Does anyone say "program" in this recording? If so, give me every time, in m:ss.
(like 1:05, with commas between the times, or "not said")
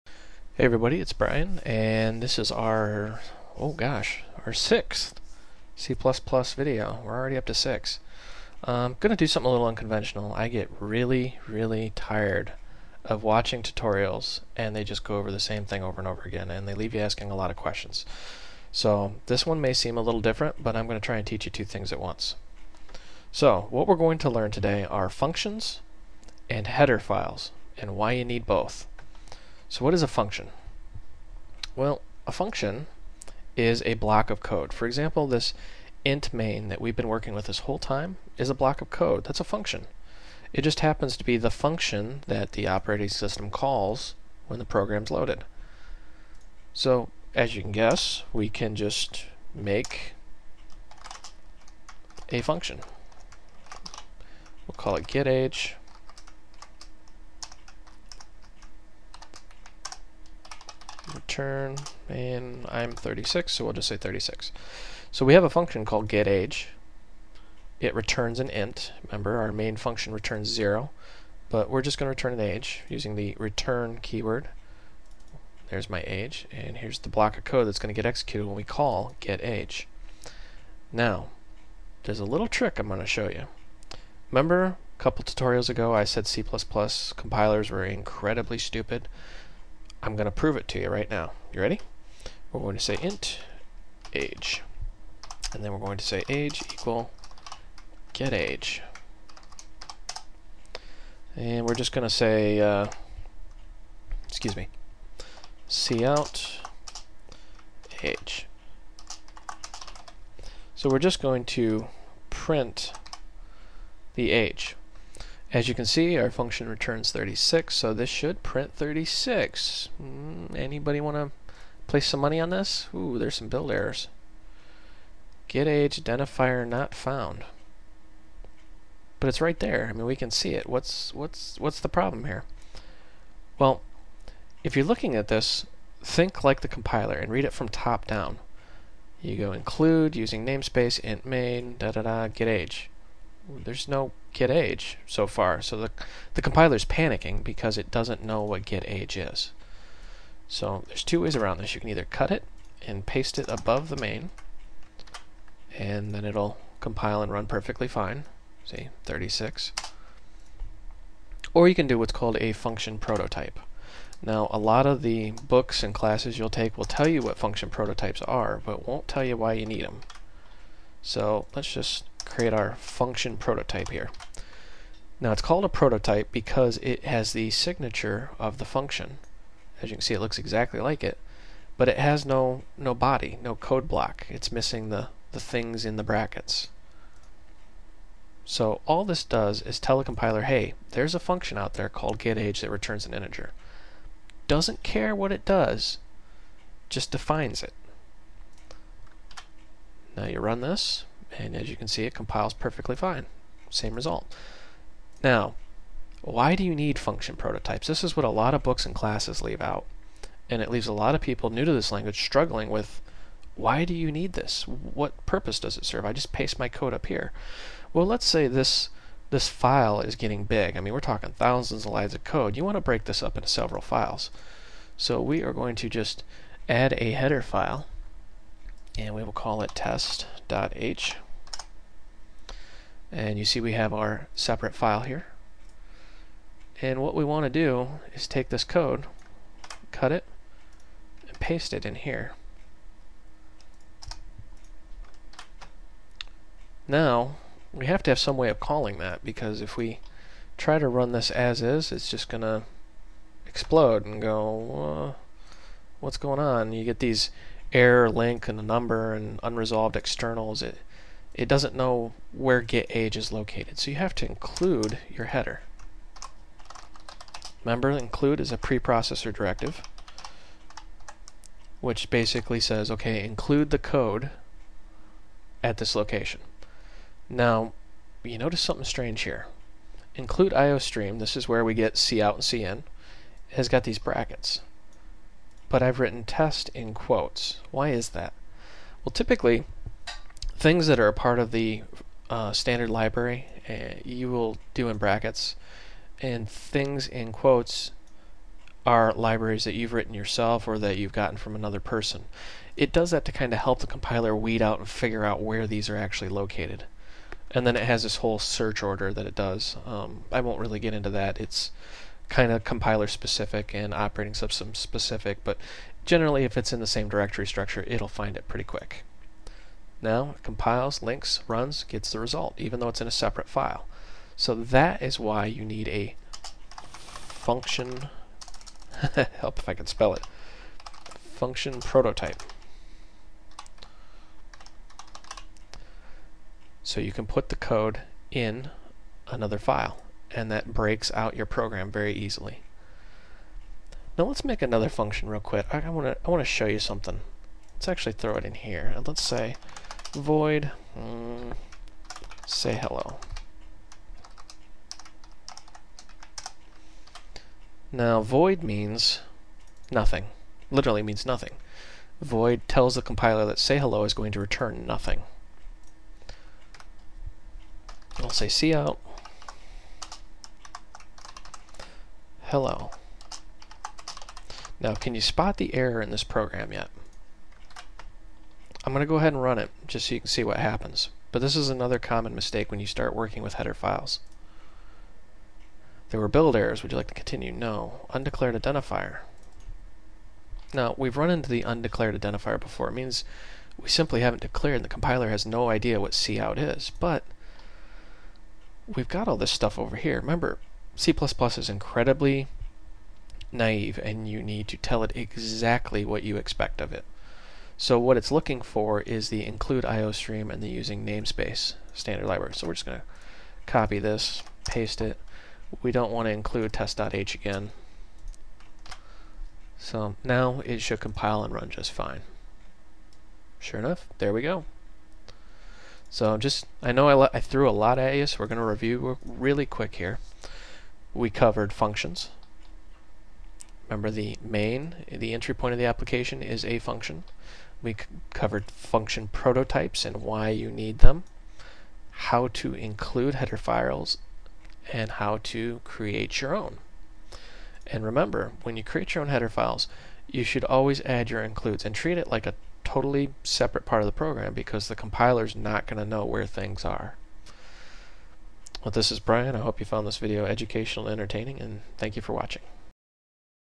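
0:44, 5:41, 6:16, 7:34.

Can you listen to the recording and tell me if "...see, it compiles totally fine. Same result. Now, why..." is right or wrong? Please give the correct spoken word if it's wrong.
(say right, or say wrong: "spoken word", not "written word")
wrong: "perfectly", not "totally".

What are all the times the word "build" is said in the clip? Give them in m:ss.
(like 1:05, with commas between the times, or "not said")
2:03, 6:26.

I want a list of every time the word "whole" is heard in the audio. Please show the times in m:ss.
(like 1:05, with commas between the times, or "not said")
0:37, 5:08.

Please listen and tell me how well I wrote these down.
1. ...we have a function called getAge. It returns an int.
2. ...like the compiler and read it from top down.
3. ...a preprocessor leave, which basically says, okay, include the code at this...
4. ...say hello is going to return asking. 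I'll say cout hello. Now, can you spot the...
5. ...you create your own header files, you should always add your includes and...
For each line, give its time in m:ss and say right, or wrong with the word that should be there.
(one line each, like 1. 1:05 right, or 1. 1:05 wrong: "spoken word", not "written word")
1. 1:05 right
2. 2:16 right
3. 4:28 wrong: "directive", not "leave"
4. 6:03 wrong: "nothing", not "asking"
5. 7:28 right.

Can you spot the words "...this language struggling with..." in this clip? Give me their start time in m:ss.
3:31.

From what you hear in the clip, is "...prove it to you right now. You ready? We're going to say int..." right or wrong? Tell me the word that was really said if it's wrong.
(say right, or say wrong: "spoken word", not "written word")
right.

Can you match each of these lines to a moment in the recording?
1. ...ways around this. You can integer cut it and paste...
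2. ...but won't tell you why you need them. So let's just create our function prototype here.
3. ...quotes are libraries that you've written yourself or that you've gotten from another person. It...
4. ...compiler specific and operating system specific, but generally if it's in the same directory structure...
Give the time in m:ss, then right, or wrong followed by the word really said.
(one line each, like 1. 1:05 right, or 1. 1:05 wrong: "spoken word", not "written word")
1. 2:31 wrong: "either", not "integer"
2. 2:48 right
3. 4:57 right
4. 5:12 right.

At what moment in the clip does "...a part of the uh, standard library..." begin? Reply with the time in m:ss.
4:51.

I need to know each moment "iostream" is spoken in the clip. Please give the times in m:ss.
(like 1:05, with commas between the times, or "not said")
4:40, 6:49.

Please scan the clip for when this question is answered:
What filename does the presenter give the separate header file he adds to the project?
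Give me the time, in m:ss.
3:49.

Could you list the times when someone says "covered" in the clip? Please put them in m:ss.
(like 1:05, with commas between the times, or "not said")
7:11, 7:18.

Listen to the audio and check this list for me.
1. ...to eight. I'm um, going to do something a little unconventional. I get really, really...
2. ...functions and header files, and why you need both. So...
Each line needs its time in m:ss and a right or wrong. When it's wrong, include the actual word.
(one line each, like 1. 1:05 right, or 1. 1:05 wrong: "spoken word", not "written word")
1. 0:07 wrong: "six", not "eight"
2. 0:25 right.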